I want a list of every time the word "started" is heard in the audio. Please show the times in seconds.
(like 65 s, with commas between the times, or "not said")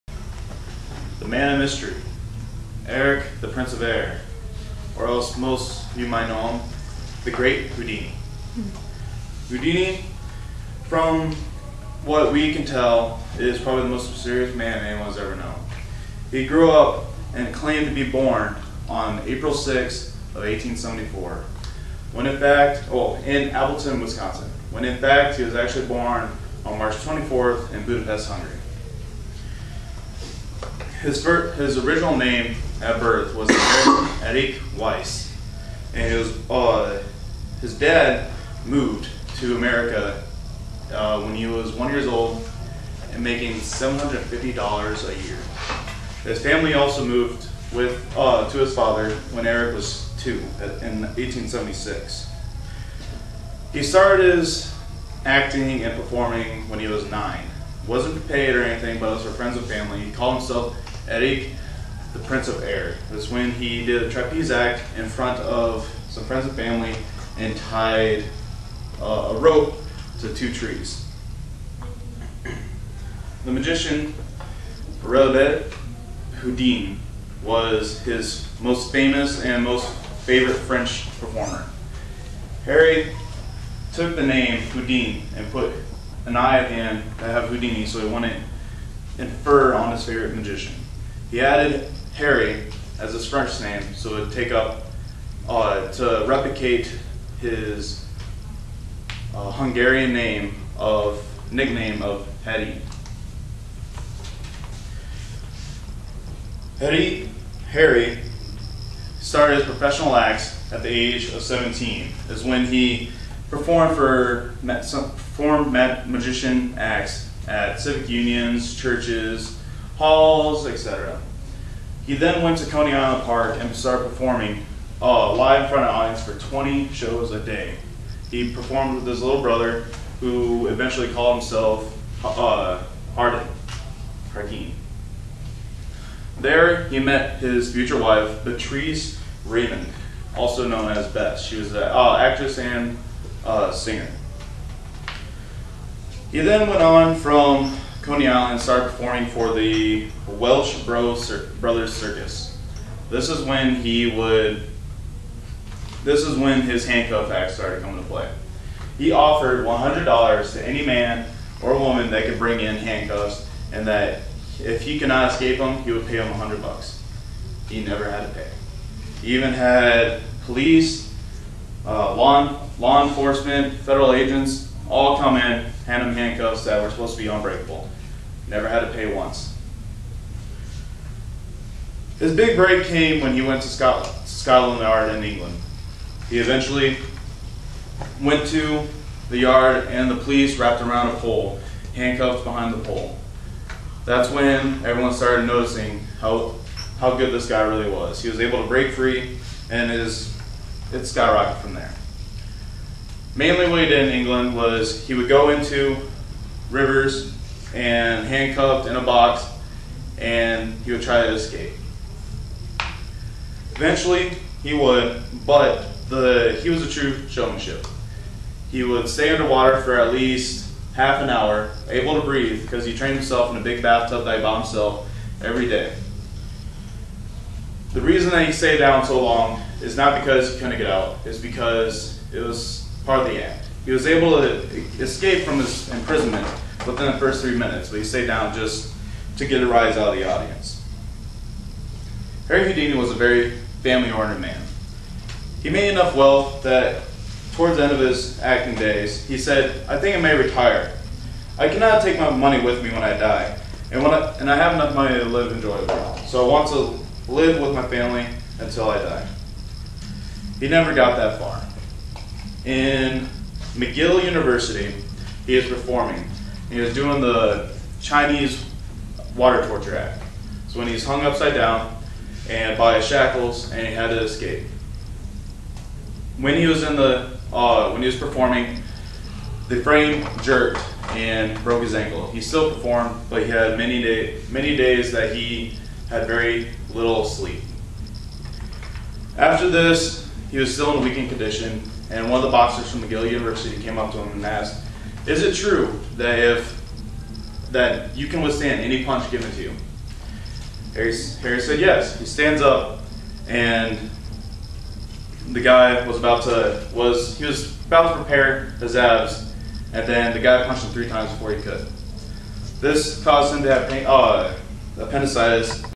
53 s, 109 s, 123 s, 148 s, 157 s, 195 s.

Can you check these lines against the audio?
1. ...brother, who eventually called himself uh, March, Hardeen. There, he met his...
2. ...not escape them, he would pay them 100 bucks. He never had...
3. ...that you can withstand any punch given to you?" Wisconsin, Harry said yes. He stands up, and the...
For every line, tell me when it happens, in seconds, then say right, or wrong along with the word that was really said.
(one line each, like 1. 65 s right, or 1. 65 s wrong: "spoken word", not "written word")
1. 129 s wrong: "Hardeen", not "March"
2. 165 s right
3. 297 s wrong: "Harry", not "Wisconsin".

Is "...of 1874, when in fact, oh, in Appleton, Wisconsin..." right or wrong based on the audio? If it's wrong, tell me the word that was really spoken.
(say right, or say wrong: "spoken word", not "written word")
right.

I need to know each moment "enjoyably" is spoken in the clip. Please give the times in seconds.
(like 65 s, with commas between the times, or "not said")
255 s.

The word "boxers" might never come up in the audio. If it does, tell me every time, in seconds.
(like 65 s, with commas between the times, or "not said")
292 s.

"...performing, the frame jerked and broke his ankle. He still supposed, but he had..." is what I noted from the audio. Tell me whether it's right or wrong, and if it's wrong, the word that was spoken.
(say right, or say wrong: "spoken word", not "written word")
wrong: "performed", not "supposed".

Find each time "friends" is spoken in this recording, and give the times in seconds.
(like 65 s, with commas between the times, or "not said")
59 s, 66 s.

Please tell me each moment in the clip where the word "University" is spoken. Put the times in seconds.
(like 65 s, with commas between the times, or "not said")
264 s, 293 s.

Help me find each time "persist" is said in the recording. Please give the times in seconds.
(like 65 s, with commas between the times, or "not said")
not said.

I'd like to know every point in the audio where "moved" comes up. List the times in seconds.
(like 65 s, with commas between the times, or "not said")
38 s, 47 s.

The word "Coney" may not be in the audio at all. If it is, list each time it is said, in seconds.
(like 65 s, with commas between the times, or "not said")
122 s, 148 s.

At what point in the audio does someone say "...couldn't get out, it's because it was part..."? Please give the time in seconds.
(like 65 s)
230 s.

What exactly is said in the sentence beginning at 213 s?
Eventually, he would, but the he was a true showmanship.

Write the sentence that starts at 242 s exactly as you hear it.
Harry Houdini was a very family-oriented man.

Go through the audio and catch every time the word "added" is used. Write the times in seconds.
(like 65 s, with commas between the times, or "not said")
91 s.